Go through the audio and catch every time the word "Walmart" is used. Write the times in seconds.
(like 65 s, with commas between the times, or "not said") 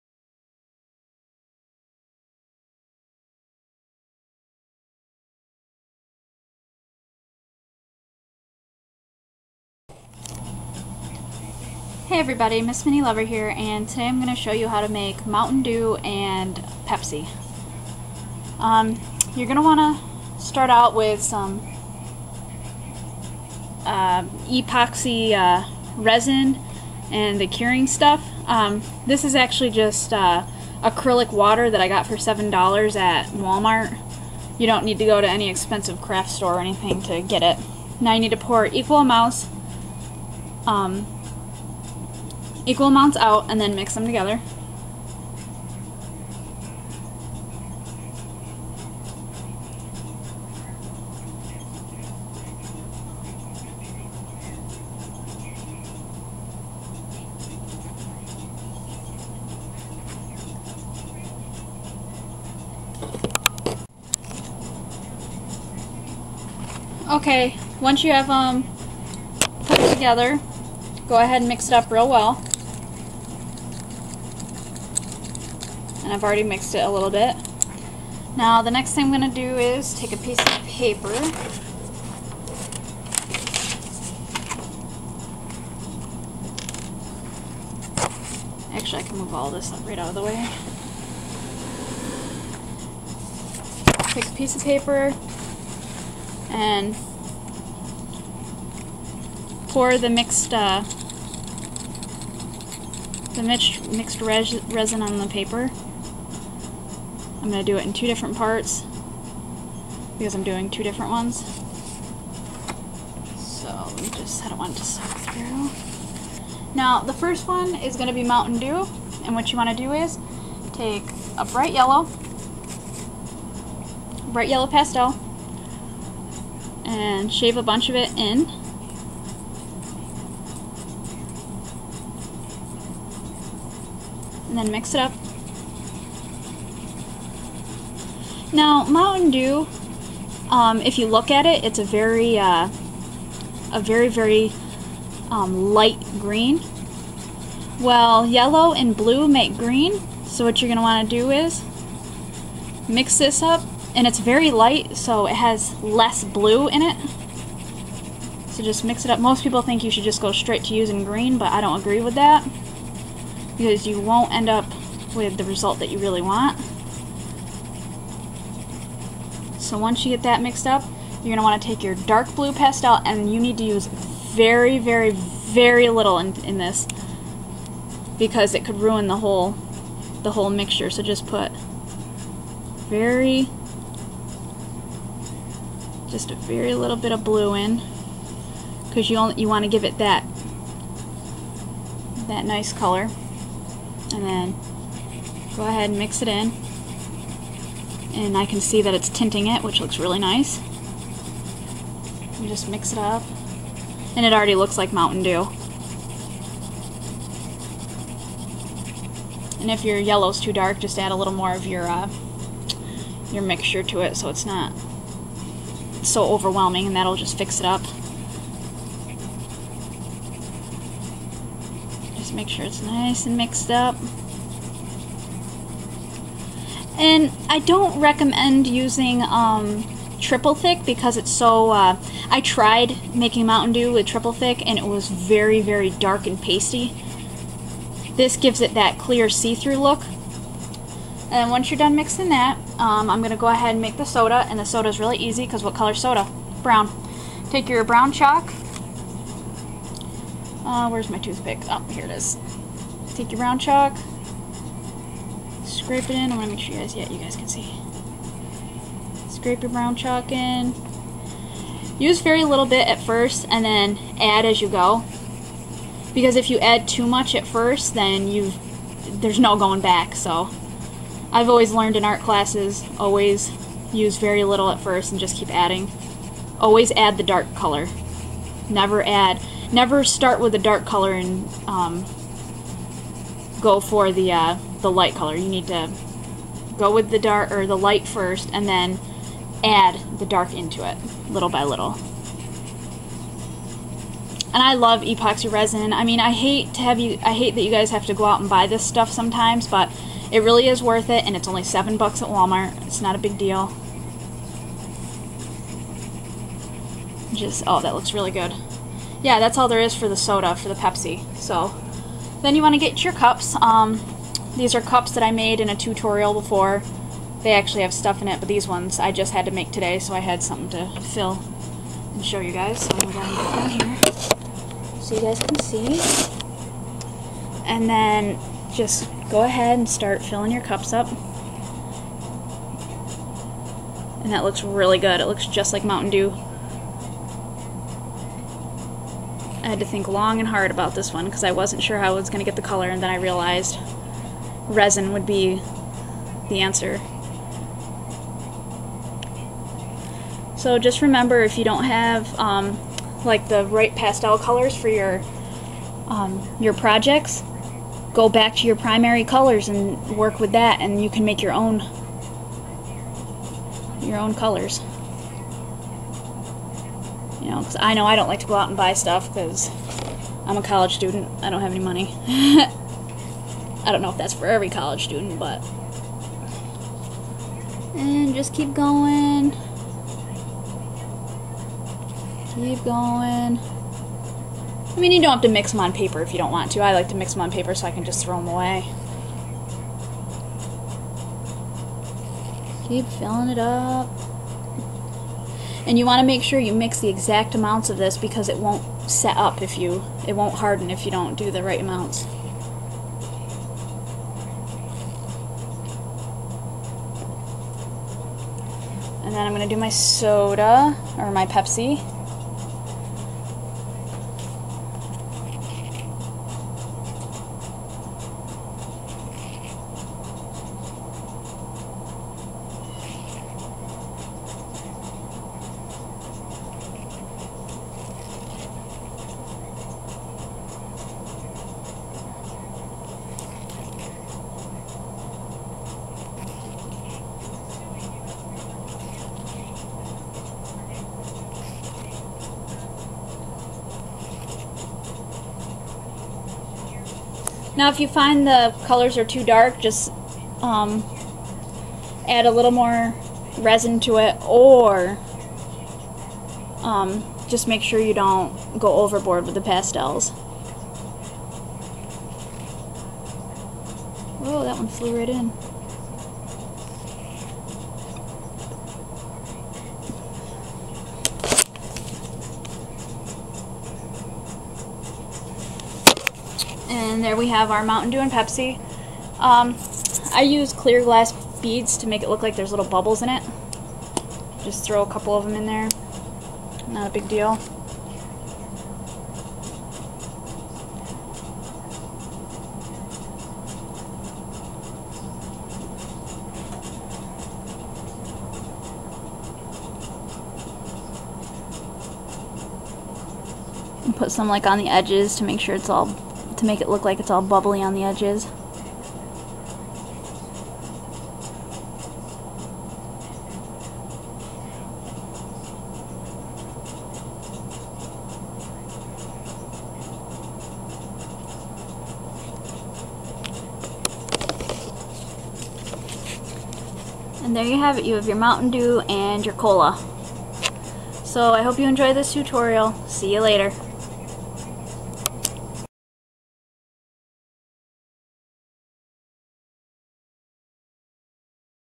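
33 s, 302 s.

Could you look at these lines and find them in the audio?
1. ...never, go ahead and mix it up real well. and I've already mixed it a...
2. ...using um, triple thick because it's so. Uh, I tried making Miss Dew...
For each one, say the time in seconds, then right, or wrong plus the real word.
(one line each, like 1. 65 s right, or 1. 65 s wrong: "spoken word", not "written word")
1. 69 s wrong: "together", not "never"
2. 228 s wrong: "Mountain", not "Miss".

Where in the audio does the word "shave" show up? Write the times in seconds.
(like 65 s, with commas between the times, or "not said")
127 s.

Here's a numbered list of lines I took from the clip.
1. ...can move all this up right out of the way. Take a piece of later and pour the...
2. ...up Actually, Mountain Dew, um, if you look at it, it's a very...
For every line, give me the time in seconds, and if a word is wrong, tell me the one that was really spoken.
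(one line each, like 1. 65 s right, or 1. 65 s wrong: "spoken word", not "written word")
1. 89 s wrong: "paper", not "later"
2. 134 s wrong: "Now", not "Actually".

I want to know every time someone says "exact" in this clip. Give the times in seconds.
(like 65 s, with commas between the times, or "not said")
397 s.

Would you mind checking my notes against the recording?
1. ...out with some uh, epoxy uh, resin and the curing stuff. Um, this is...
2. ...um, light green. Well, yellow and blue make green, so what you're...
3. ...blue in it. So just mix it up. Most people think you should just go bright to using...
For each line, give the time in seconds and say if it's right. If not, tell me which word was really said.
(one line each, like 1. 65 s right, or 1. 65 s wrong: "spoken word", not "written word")
1. 20 s right
2. 145 s right
3. 156 s wrong: "straight", not "bright".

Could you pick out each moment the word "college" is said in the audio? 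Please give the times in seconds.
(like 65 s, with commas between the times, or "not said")
370 s, 374 s.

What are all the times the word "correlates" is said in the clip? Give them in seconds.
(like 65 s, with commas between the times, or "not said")
not said.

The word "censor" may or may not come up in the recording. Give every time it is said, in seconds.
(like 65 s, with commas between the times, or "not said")
not said.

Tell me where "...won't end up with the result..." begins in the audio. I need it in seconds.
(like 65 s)
164 s.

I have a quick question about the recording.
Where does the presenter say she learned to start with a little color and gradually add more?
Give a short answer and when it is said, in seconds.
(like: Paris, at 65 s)
art classes, at 272 s.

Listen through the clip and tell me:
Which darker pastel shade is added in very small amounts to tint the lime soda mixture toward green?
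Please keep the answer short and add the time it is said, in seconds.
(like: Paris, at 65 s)
dark blue, at 171 s.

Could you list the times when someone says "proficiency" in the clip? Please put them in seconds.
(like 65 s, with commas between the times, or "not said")
not said.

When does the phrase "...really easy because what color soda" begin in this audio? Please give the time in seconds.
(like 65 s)
244 s.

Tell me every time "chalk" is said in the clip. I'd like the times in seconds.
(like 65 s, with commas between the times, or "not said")
248 s, 253 s, 259 s.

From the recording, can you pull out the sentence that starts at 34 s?
You don't need to go to any expensive craft store or anything to get it.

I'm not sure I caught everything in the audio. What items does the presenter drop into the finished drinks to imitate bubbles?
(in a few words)
clear glass beads.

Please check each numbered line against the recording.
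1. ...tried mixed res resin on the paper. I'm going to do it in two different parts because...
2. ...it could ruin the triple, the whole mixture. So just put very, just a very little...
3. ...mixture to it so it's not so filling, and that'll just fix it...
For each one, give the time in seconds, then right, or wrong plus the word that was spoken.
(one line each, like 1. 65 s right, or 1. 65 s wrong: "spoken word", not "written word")
1. 103 s wrong: "mixed", not "tried"
2. 178 s wrong: "whole", not "triple"
3. 213 s wrong: "overwhelming", not "filling".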